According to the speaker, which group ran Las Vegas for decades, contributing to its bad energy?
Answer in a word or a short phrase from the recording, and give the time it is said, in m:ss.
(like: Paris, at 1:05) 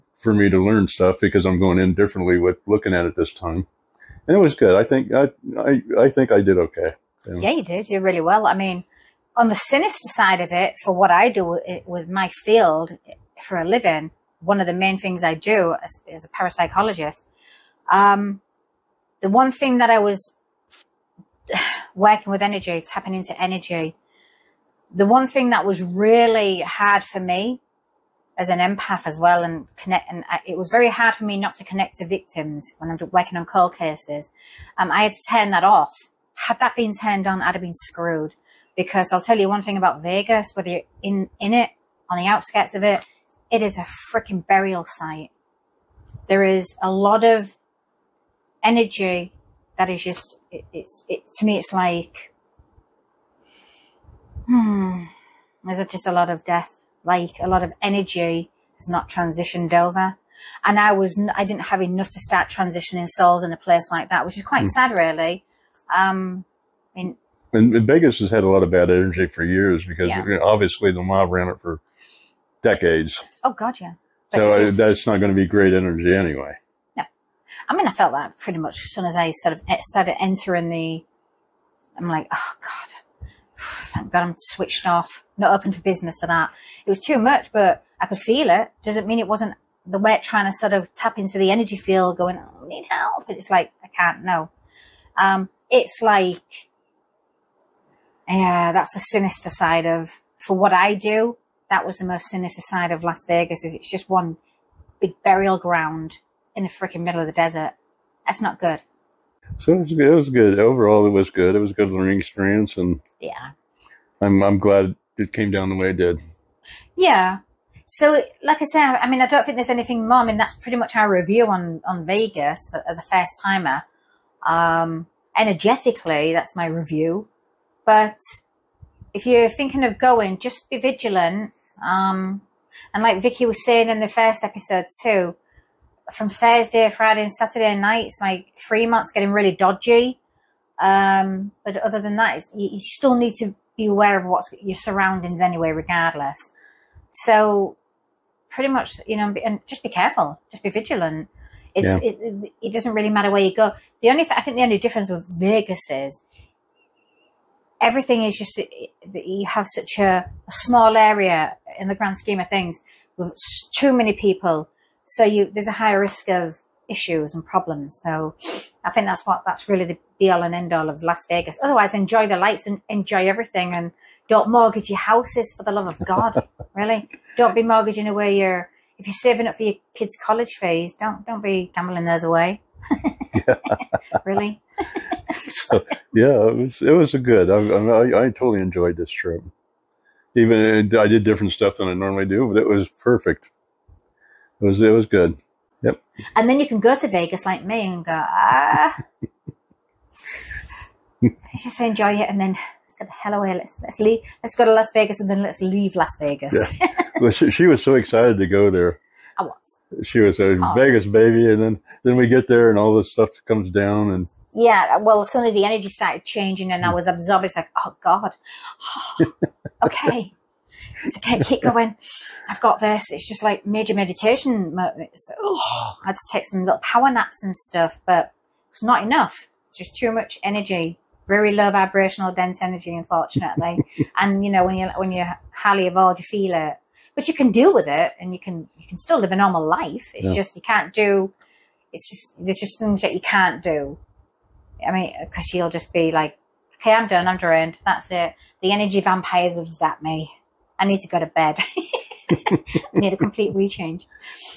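the mob, at 1:10.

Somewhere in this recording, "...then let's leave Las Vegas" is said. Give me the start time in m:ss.
3:25.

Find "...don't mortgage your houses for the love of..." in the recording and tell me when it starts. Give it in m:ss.
2:54.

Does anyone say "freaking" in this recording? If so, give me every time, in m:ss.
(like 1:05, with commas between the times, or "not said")
0:44, 1:46.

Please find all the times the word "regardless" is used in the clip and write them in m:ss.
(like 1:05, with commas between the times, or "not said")
2:25.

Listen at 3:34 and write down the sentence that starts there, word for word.
Yeah, well, as soon as the energy started changing and I mm.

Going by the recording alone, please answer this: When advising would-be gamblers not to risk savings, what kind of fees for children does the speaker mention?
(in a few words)
college fees.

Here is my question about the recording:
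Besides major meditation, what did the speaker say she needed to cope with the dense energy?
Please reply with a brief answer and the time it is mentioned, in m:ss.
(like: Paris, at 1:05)
power naps, at 3:46.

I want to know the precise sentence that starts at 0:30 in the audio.
And I, it was very hard for me not to connect to victims when I'm working on cold cases.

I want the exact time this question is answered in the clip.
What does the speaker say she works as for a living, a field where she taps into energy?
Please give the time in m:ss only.
0:16.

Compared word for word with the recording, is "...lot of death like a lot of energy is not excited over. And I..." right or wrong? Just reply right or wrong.
wrong.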